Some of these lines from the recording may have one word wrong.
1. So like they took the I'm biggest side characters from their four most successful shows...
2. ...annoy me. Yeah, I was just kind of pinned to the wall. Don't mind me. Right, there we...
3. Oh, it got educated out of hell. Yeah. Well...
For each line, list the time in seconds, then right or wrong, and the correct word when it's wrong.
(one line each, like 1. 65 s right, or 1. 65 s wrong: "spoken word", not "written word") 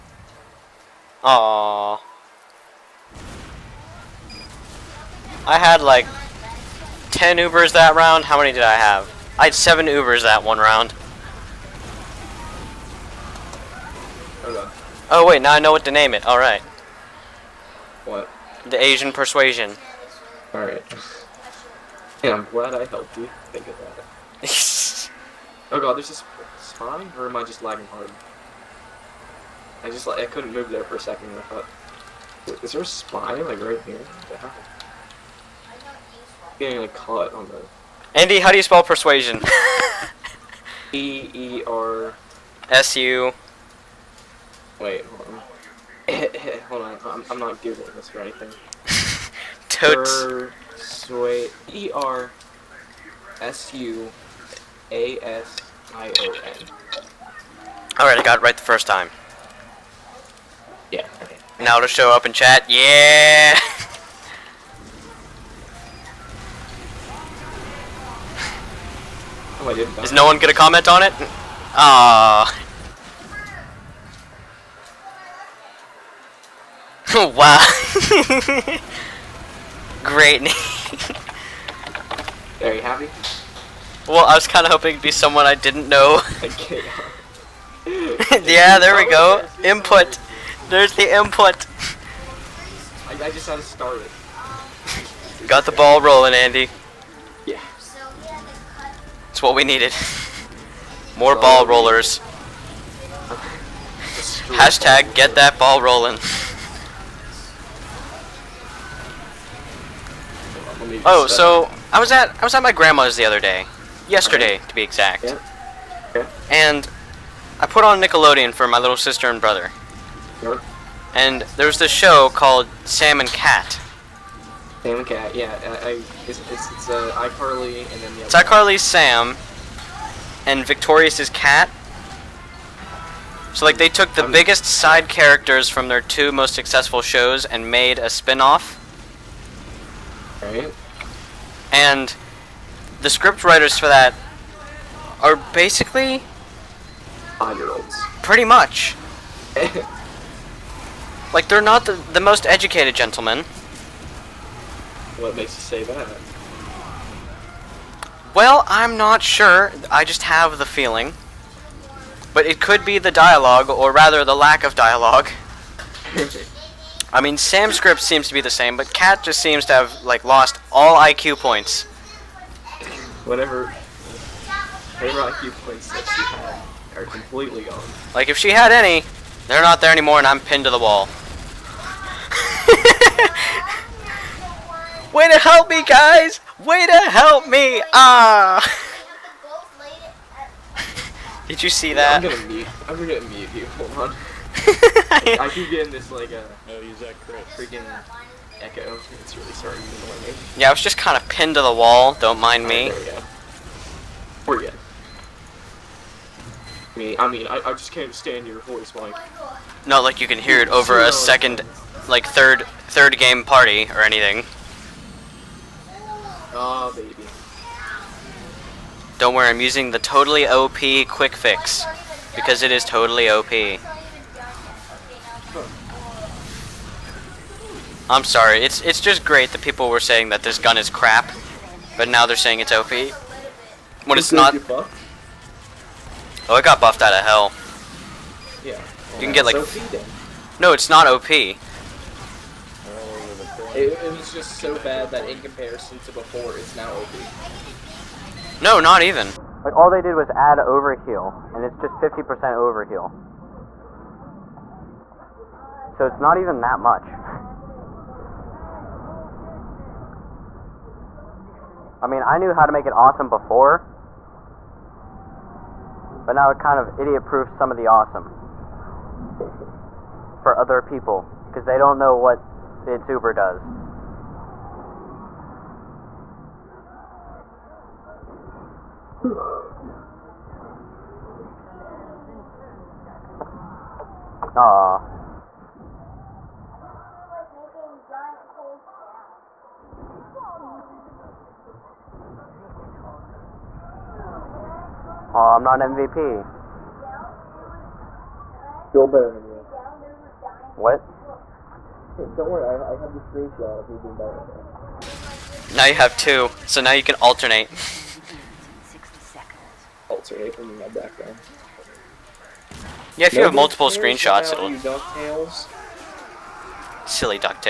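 1. 133 s wrong: "two", not "four"
2. 200 s right
3. 236 s wrong: "buffed", not "educated".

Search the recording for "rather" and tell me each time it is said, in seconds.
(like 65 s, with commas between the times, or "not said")
163 s.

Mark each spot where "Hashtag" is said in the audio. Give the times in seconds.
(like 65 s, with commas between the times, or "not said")
104 s.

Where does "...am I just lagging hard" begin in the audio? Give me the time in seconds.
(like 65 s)
27 s.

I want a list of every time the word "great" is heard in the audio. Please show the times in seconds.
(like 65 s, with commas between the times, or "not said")
80 s, 229 s.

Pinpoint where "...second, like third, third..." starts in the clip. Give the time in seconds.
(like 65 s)
211 s.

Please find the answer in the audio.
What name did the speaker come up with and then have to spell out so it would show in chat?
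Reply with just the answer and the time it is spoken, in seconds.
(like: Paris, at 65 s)
The Asian Persuasion, at 18 s.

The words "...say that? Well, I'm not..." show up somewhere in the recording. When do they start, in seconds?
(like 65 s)
155 s.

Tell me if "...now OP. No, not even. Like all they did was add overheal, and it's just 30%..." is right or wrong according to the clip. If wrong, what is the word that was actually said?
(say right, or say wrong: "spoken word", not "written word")
wrong: "50", not "30".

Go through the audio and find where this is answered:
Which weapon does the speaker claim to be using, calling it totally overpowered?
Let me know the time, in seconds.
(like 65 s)
221 s.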